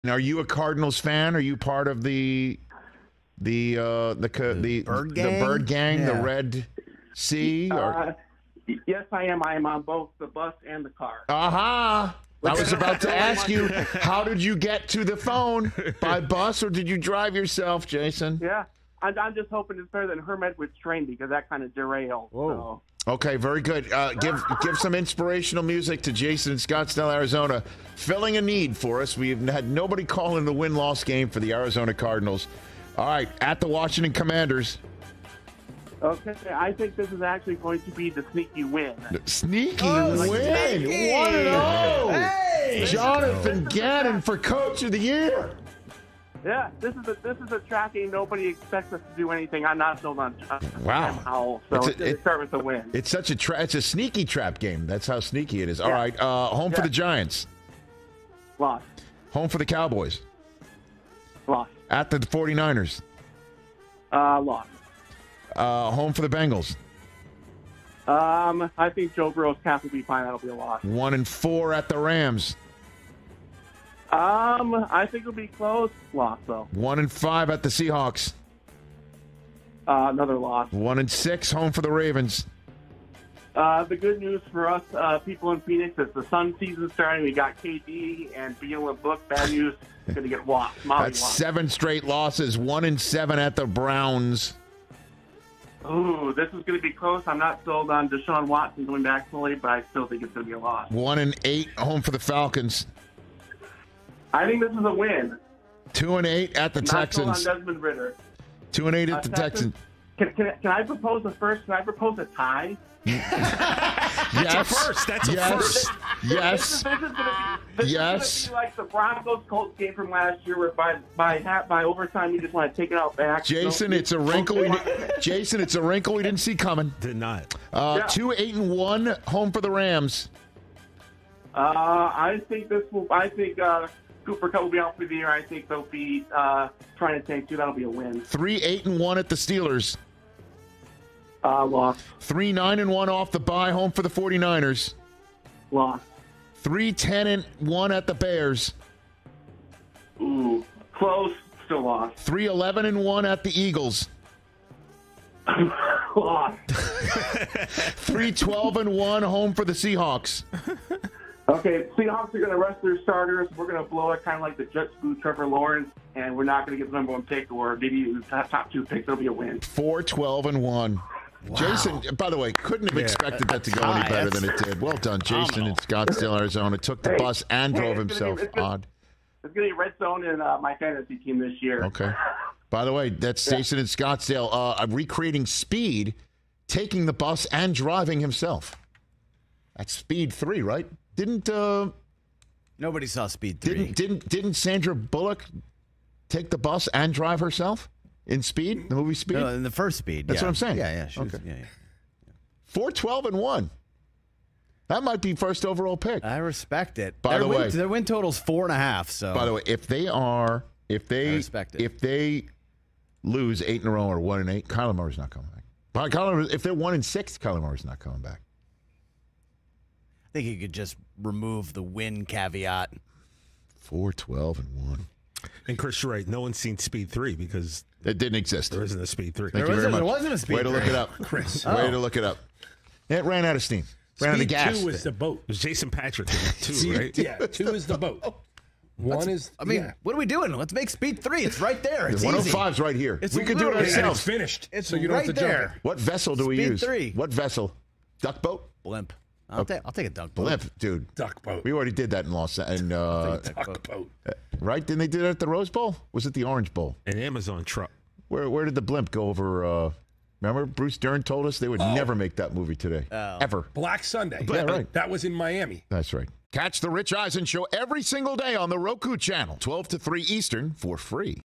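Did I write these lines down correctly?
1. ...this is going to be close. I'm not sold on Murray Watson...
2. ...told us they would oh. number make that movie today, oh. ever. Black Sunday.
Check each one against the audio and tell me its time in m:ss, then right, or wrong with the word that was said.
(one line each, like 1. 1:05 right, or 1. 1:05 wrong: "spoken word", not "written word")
1. 1:36 wrong: "Deshaun", not "Murray"
2. 4:21 wrong: "never", not "number".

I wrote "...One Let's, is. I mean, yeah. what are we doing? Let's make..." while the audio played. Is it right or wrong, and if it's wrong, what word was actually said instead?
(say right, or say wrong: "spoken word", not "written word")
right.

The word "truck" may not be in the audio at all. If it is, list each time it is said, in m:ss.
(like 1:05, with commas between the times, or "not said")
4:17.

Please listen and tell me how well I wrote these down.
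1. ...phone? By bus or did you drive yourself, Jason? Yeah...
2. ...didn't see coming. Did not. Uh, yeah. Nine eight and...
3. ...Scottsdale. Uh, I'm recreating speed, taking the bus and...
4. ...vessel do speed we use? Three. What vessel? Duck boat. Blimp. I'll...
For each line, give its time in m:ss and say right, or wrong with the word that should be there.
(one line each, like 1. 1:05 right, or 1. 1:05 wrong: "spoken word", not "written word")
1. 0:15 right
2. 2:06 wrong: "Two", not "Nine"
3. 3:03 right
4. 4:05 right.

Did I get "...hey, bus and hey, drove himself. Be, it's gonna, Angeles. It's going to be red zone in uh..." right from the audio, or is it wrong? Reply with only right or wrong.
wrong.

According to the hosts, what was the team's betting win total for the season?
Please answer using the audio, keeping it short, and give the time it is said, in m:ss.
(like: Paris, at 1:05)
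4.5, at 3:28.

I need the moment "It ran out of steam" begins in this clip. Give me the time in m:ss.
3:53.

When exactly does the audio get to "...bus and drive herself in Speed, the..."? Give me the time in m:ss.
3:16.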